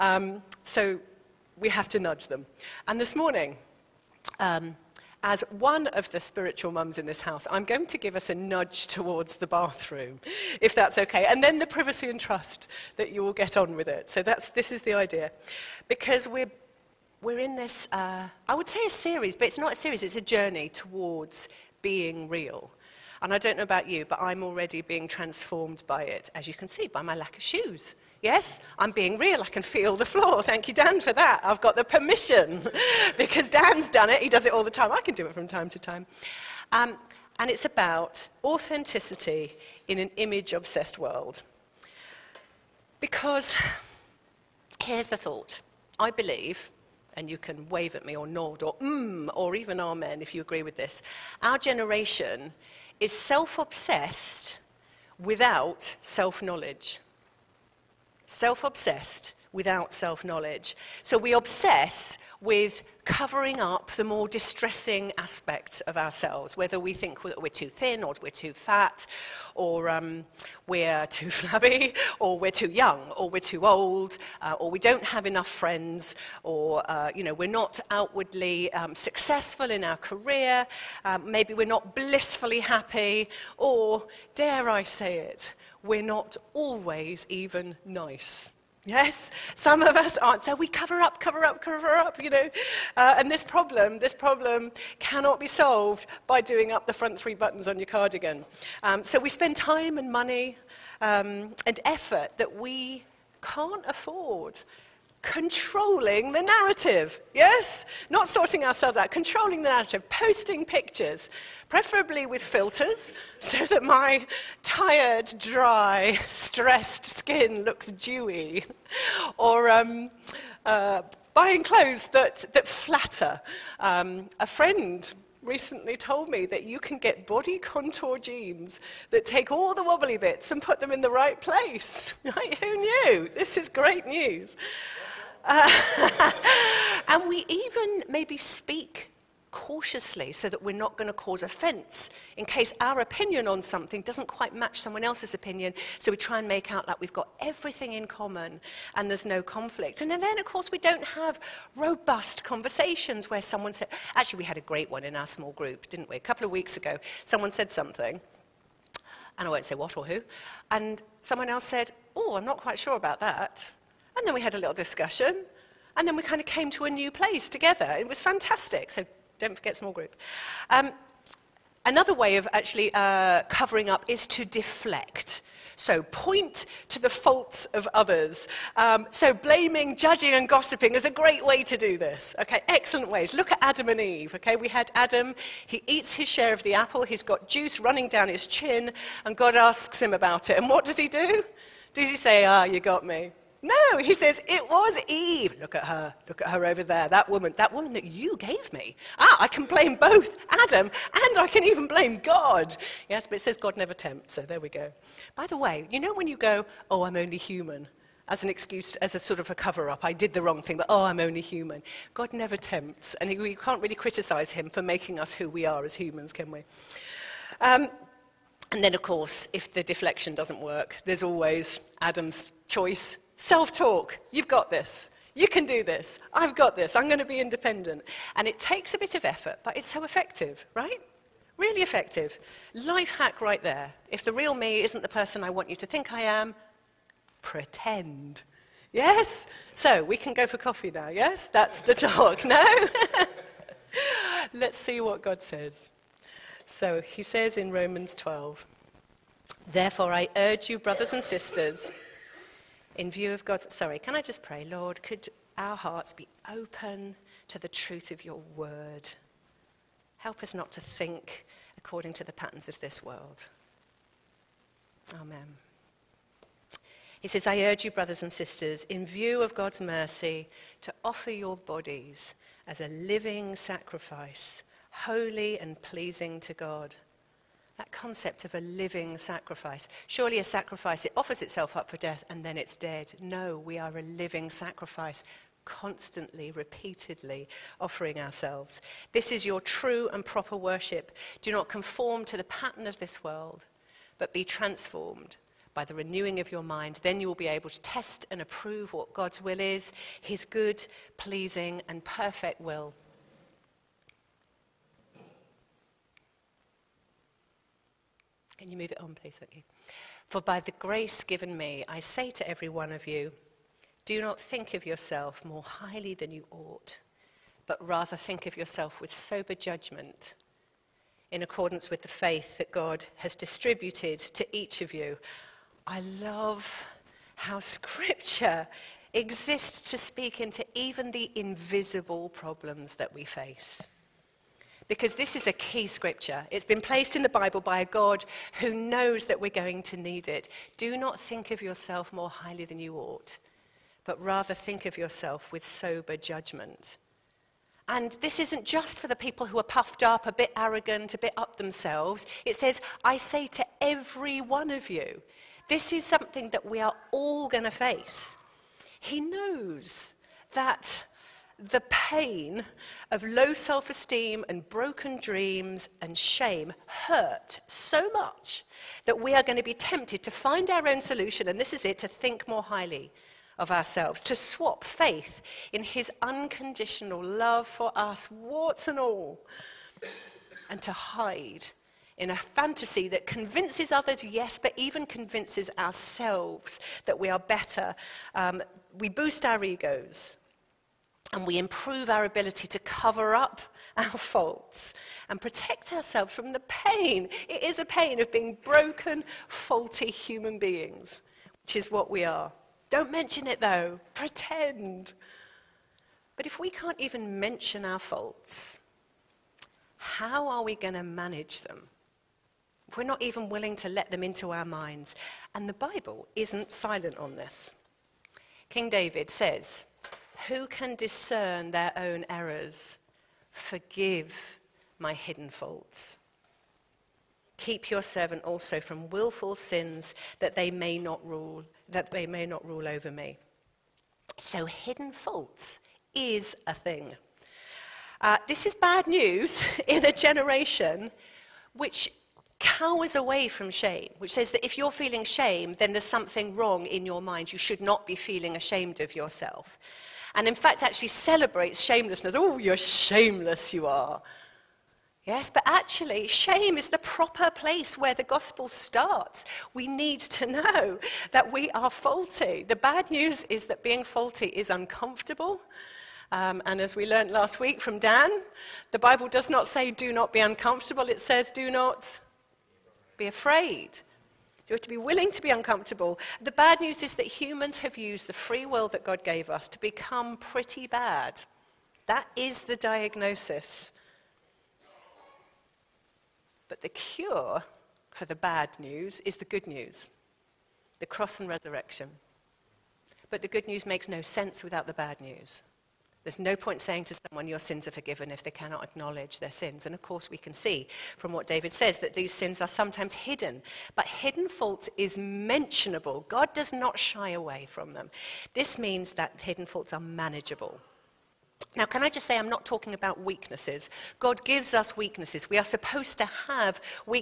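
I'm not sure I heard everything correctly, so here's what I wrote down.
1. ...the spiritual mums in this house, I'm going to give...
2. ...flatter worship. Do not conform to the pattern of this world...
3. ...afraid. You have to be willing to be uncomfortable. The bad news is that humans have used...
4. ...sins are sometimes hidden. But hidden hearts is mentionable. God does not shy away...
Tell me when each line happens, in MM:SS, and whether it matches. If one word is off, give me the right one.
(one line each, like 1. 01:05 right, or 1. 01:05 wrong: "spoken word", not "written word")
1. 00:06 right
2. 04:50 wrong: "proper", not "flatter"
3. 07:53 right
4. 08:22 wrong: "faults", not "hearts".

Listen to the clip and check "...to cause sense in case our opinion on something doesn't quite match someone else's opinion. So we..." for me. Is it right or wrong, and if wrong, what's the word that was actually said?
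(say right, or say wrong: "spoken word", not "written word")
wrong: "offense", not "sense".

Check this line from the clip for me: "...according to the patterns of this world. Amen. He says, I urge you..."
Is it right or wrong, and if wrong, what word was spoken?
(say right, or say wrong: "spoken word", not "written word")
right.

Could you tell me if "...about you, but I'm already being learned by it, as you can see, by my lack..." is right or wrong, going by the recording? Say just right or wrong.
wrong.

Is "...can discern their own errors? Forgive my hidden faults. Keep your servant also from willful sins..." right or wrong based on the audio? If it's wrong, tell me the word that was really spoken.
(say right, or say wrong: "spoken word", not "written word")
right.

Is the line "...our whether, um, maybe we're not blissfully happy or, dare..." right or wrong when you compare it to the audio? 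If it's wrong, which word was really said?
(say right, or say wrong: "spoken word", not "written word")
wrong: "career", not "whether".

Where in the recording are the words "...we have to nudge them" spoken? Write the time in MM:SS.
00:01.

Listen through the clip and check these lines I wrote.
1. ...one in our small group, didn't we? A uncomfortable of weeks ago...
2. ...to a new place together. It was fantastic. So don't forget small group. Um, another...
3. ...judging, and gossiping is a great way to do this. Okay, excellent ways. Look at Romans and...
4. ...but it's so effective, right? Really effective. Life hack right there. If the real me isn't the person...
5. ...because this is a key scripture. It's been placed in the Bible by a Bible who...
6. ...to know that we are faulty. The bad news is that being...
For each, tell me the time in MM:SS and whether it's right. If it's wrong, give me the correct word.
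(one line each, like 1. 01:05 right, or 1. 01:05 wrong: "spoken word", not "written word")
1. 02:34 wrong: "couple", not "uncomfortable"
2. 02:46 right
3. 02:59 wrong: "Adam", not "Romans"
4. 03:49 right
5. 05:34 wrong: "God", not "Bible"
6. 07:40 right.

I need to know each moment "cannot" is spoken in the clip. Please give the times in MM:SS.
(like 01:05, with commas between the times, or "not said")
01:34, 08:18.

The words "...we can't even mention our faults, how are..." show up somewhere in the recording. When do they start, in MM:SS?
06:46.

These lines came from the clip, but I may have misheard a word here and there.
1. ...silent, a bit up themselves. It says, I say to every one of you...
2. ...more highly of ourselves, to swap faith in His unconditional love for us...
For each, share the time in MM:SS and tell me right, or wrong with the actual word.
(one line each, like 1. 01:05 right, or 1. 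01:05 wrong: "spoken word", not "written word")
1. 05:50 wrong: "arrogant", not "silent"
2. 06:12 right.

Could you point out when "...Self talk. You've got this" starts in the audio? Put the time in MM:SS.
03:43.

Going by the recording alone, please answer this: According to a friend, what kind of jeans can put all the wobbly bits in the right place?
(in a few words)
Body contour jeans.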